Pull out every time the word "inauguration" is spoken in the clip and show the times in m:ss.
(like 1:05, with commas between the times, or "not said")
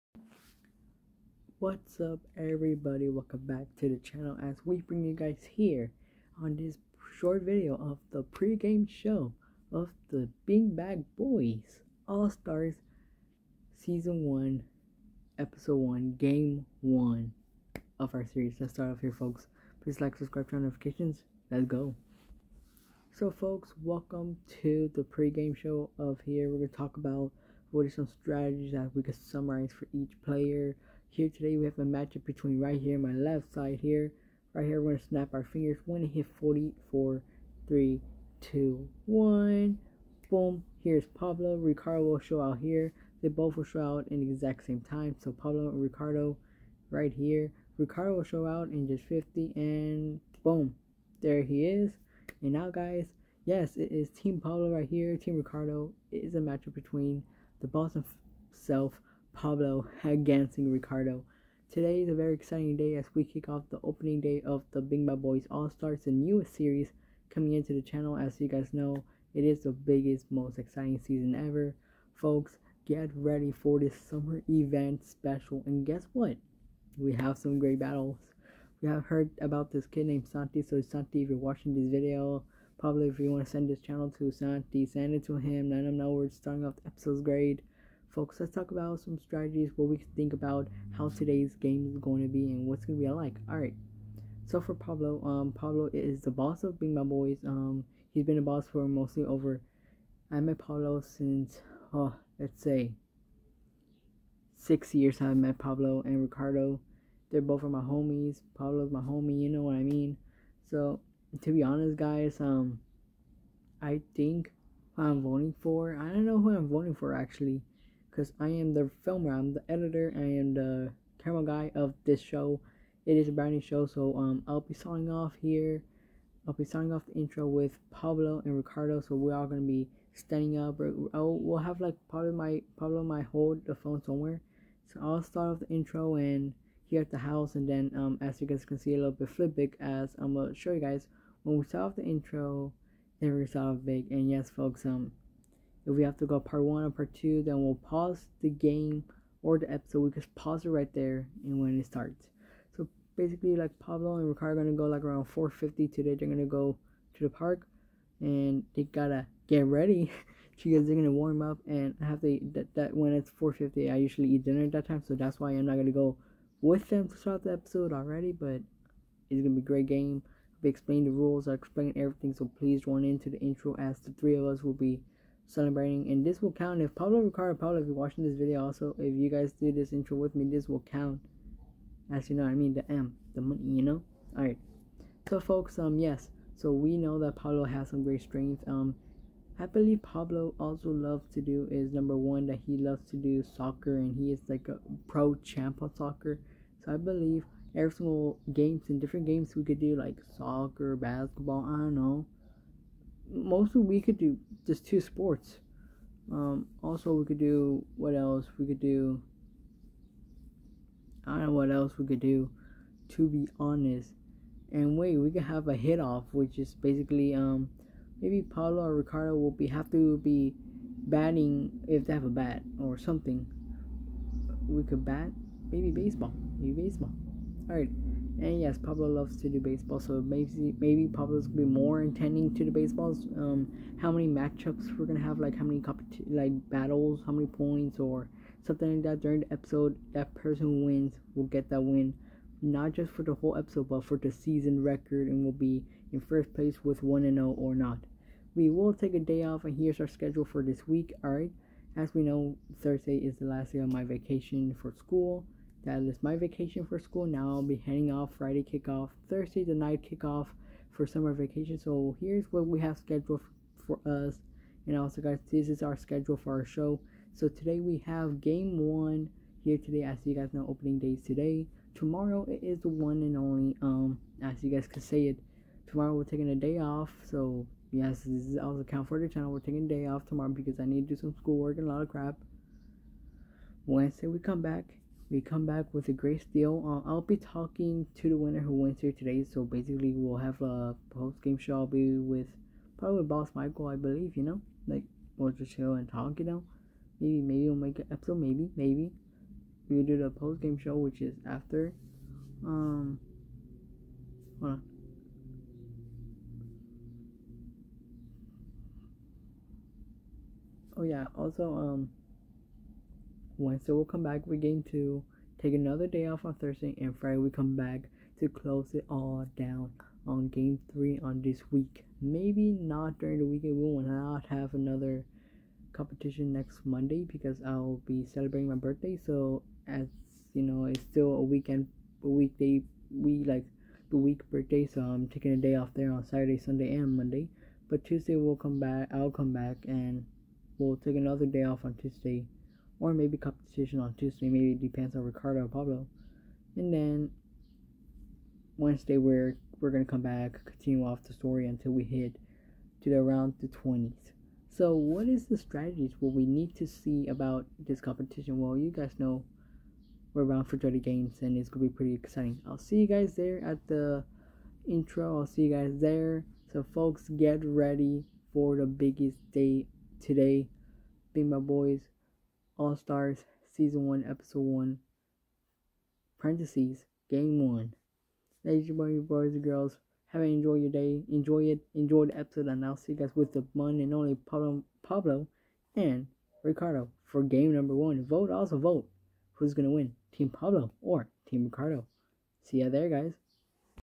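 not said.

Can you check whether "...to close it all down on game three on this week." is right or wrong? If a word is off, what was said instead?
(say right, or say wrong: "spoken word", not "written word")
right.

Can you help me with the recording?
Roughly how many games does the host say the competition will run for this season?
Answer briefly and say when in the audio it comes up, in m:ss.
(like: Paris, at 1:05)
30, at 6:00.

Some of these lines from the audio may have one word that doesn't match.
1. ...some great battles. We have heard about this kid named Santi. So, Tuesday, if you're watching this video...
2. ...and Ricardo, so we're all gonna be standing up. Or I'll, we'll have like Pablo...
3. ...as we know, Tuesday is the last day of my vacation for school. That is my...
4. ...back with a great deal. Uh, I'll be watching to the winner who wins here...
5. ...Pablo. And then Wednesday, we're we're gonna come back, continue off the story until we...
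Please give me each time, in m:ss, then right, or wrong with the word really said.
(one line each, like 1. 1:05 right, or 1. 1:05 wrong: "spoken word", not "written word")
1. 1:17 wrong: "Santi", not "Tuesday"
2. 2:08 right
3. 4:11 wrong: "Thursday", not "Tuesday"
4. 4:45 wrong: "talking", not "watching"
5. 5:45 right.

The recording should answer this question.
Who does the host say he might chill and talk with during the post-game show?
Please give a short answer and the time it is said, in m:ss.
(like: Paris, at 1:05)
Boss Michael, at 4:53.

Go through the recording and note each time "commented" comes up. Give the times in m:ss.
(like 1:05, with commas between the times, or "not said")
not said.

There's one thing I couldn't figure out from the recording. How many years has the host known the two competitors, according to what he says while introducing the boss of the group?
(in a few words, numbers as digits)
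6.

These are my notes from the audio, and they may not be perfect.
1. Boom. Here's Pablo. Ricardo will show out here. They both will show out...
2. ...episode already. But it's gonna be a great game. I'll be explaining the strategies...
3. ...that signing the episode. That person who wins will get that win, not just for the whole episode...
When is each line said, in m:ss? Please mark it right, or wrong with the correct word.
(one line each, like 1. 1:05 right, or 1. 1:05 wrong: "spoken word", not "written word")
1. 0:40 right
2. 2:47 wrong: "rules", not "strategies"
3. 3:59 wrong: "during", not "signing".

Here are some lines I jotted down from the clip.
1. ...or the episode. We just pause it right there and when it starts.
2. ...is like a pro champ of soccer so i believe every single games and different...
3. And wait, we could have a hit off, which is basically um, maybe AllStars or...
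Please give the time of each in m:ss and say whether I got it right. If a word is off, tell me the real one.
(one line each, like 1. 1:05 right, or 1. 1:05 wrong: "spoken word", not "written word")
1. 2:29 right
2. 3:14 right
3. 3:34 wrong: "Paulo", not "AllStars".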